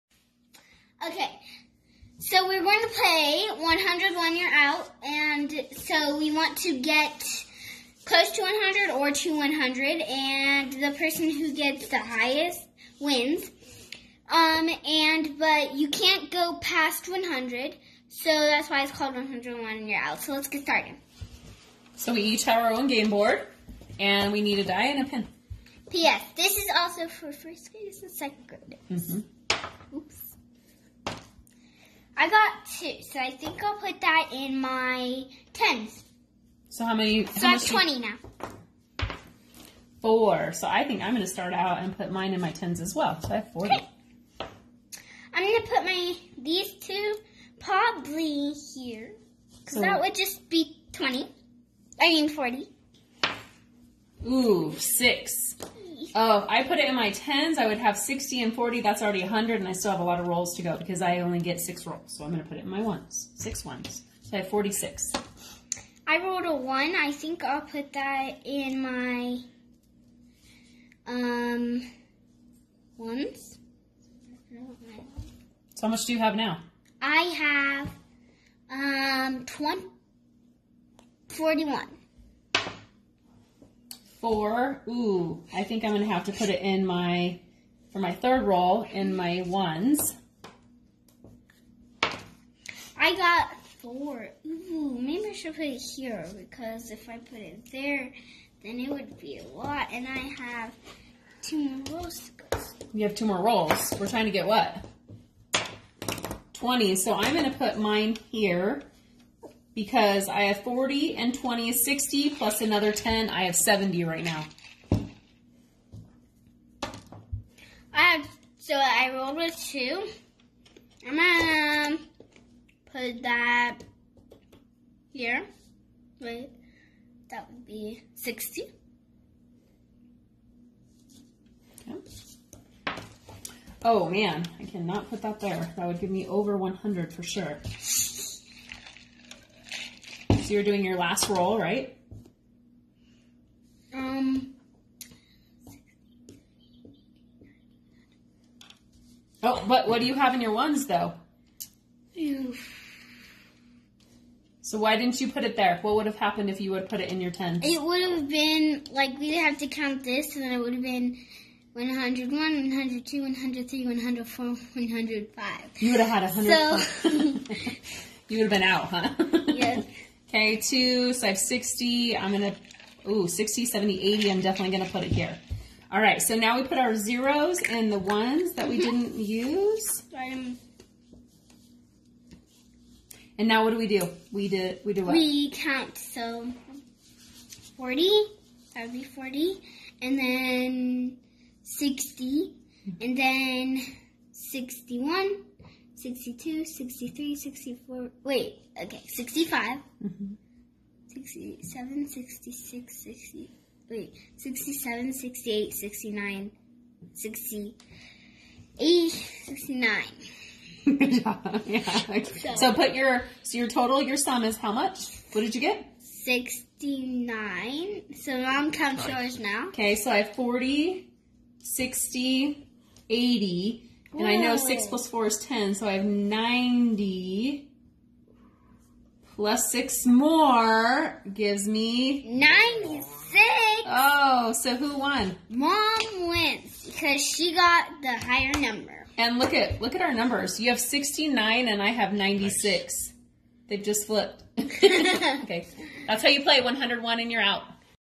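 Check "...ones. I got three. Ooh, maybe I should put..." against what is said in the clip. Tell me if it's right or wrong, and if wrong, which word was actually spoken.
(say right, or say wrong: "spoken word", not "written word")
wrong: "four", not "three".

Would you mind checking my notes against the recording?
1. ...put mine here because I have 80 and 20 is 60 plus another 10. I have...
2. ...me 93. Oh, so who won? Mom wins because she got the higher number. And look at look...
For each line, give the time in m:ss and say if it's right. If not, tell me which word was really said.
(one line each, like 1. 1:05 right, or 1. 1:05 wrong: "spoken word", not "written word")
1. 1:47 wrong: "40", not "80"
2. 3:51 wrong: "96", not "93".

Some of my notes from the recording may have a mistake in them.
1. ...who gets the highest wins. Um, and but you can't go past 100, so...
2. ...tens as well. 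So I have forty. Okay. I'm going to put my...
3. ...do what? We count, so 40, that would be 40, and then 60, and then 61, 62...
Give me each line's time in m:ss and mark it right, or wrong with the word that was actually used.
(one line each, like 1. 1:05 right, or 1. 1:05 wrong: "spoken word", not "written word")
1. 0:11 right
2. 0:42 right
3. 3:04 right.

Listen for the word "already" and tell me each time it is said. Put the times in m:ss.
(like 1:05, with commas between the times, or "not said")
0:59.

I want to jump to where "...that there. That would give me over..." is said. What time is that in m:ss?
2:15.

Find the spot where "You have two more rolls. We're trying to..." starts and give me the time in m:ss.
1:42.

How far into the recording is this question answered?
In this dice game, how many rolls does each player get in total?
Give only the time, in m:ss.
1:01.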